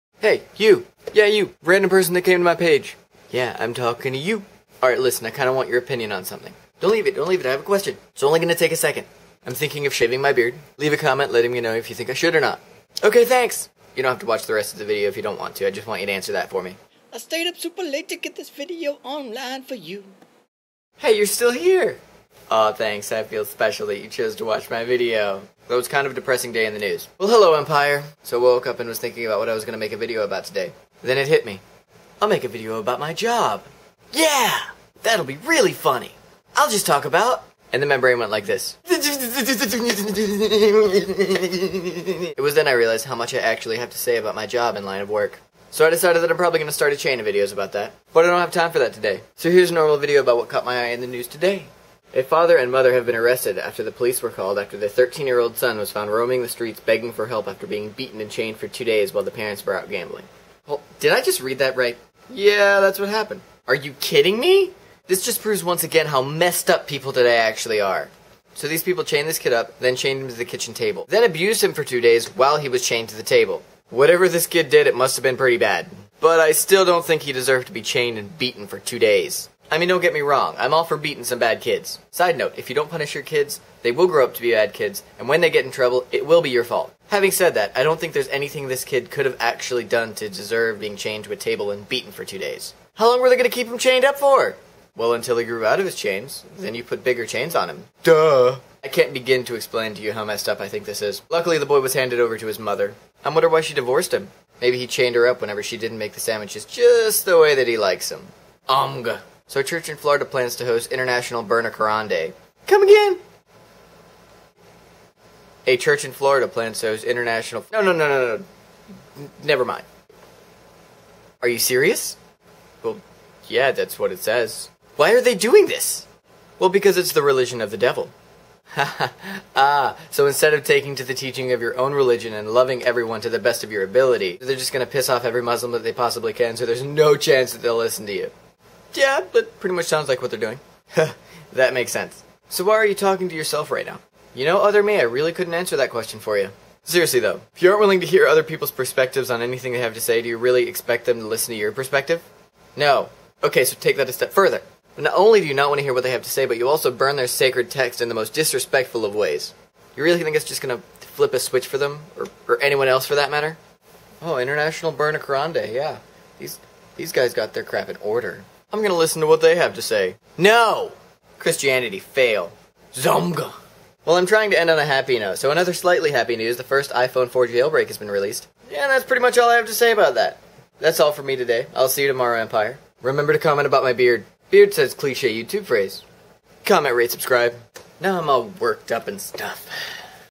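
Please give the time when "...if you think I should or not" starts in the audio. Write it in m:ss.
0:11.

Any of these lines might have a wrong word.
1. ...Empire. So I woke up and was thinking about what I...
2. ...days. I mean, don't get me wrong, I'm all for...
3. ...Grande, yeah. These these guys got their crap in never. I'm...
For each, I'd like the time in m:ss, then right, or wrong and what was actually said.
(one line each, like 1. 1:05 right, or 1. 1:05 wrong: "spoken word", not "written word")
1. 0:27 right
2. 1:18 right
3. 2:45 wrong: "order", not "never".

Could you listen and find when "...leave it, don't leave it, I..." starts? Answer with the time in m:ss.
0:06.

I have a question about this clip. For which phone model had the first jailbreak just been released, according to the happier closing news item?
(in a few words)
iPhone 4.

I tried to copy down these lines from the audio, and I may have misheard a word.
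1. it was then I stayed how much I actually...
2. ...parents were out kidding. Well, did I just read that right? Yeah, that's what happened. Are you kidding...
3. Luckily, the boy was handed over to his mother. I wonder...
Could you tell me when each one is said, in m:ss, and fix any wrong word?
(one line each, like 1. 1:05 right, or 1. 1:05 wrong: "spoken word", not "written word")
1. 0:38 wrong: "realized", not "stayed"
2. 0:59 wrong: "gambling", not "kidding"
3. 1:41 right.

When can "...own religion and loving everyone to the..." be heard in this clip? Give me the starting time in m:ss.
2:11.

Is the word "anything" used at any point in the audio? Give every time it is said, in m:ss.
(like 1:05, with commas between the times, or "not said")
1:28, 2:29.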